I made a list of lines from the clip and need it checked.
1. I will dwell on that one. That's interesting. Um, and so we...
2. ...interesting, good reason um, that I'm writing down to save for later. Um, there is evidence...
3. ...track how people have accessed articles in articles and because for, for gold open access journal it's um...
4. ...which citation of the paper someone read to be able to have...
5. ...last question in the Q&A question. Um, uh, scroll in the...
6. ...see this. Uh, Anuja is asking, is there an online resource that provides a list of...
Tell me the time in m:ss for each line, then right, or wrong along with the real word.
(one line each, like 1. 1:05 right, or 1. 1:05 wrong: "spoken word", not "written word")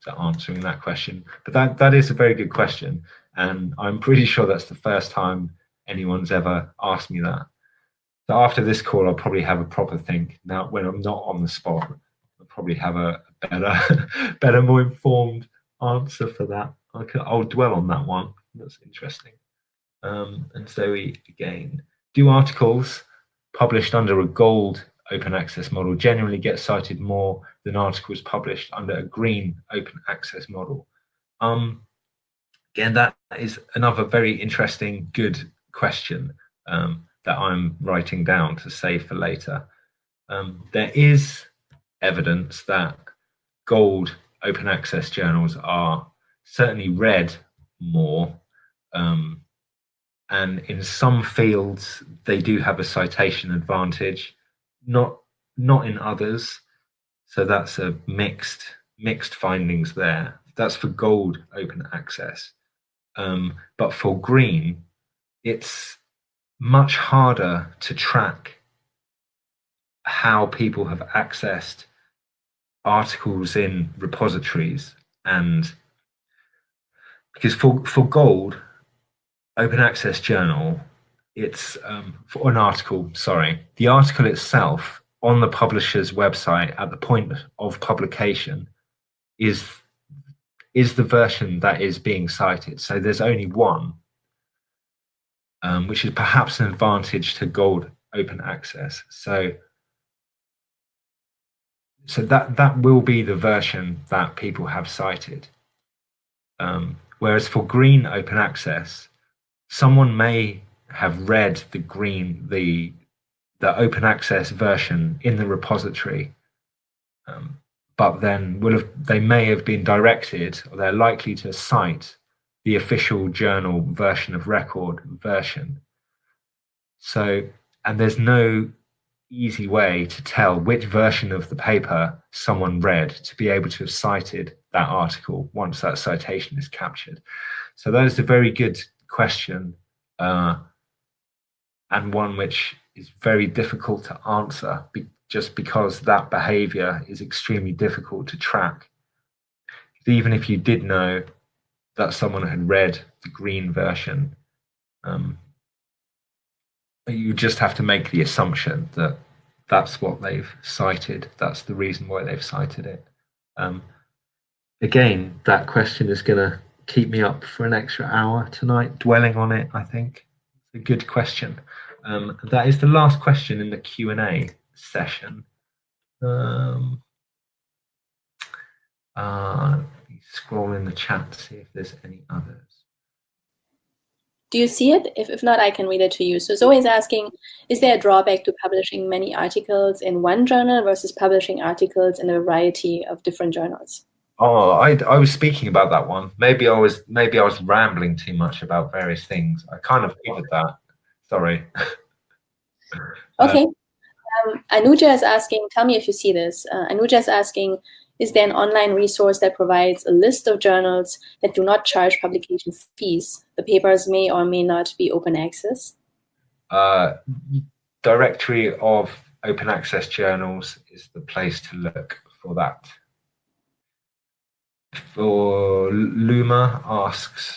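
1. 0:16 right
2. 0:34 wrong: "question", not "reason"
3. 1:07 wrong: "repositories", not "articles"
4. 2:10 wrong: "version", not "citation"
5. 2:52 wrong: "session", not "question"
6. 3:26 right.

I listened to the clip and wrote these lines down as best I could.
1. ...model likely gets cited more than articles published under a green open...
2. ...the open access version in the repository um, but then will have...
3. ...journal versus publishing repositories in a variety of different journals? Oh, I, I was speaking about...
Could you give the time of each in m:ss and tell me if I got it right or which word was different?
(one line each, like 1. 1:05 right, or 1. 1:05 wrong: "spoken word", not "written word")
1. 0:25 wrong: "generally", not "likely"
2. 1:53 right
3. 3:10 wrong: "articles", not "repositories".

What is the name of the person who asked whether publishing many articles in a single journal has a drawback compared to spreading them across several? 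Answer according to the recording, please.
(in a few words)
Zoe.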